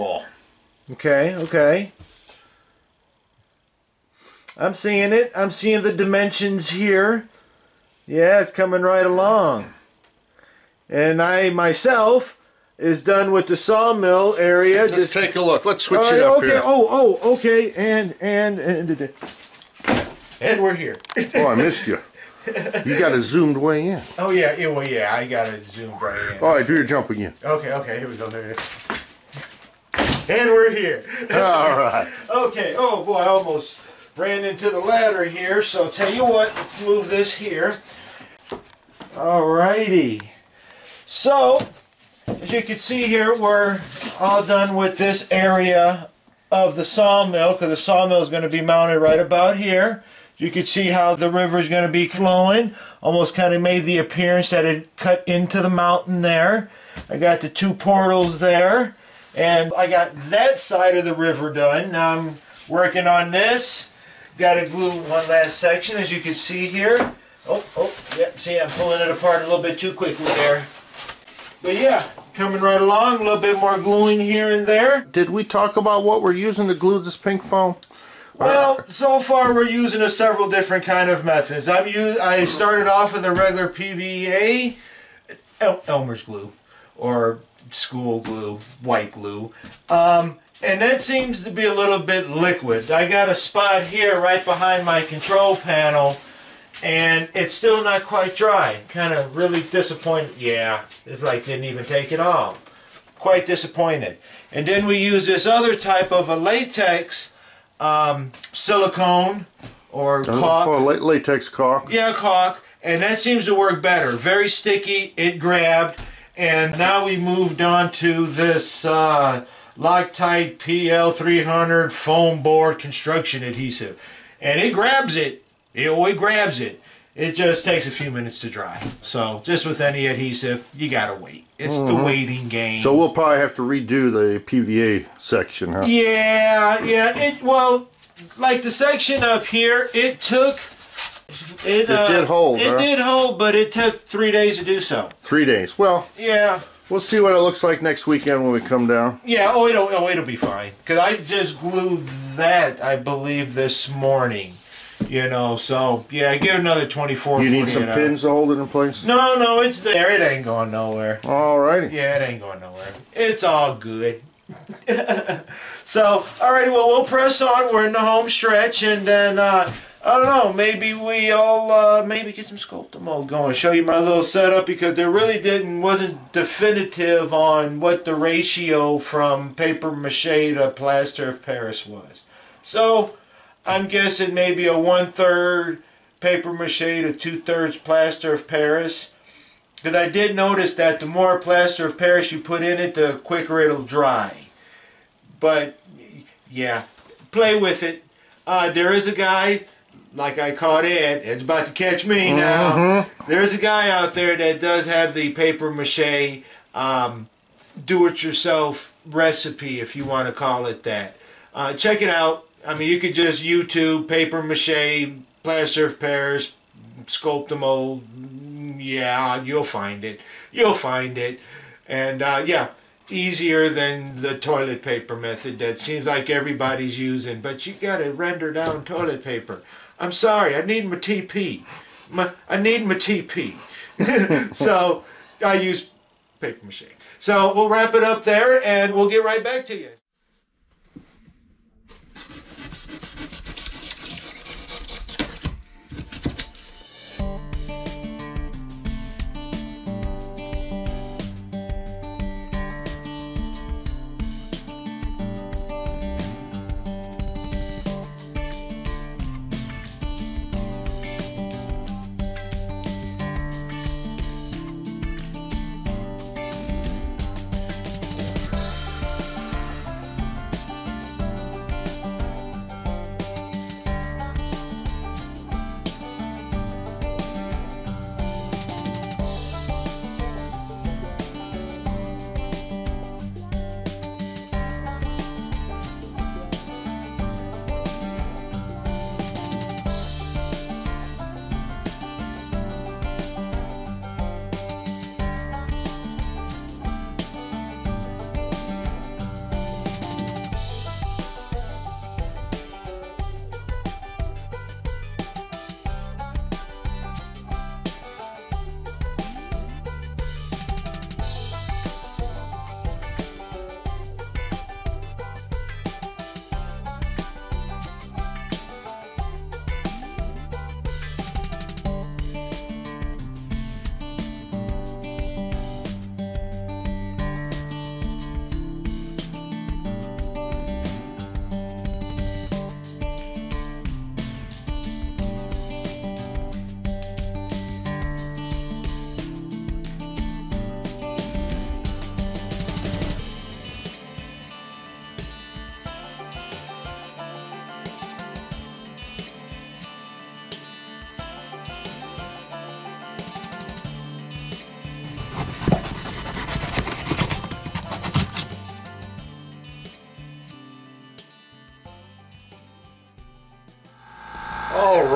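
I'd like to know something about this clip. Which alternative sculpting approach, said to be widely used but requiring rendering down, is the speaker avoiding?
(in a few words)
Toilet paper method.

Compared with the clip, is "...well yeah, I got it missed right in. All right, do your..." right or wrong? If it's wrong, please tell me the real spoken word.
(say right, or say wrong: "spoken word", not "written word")
wrong: "zoomed", not "missed".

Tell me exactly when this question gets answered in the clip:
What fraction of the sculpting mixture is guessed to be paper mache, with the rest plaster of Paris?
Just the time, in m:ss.
3:04.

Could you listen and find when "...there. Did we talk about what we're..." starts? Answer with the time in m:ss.
1:14.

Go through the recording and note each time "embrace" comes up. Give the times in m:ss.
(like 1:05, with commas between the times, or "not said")
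not said.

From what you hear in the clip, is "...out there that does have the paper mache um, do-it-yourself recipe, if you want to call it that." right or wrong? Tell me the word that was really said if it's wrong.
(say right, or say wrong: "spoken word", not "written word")
right.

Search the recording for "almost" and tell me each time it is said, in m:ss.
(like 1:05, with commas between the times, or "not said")
0:33, 0:53.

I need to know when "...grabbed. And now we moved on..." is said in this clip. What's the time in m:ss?
1:55.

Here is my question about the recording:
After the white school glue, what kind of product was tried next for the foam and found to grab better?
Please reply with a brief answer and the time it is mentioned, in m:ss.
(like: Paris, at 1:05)
Latex caulk, at 1:50.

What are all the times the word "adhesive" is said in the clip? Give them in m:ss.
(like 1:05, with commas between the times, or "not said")
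2:03, 2:10.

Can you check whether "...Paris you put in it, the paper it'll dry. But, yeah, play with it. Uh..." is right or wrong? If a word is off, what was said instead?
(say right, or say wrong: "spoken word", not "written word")
wrong: "quicker", not "paper".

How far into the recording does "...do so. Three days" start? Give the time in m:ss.
2:24.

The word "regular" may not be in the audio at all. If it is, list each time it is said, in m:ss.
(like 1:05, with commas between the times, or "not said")
1:23.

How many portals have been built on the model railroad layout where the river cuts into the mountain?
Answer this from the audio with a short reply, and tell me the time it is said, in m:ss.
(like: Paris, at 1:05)
2, at 0:57.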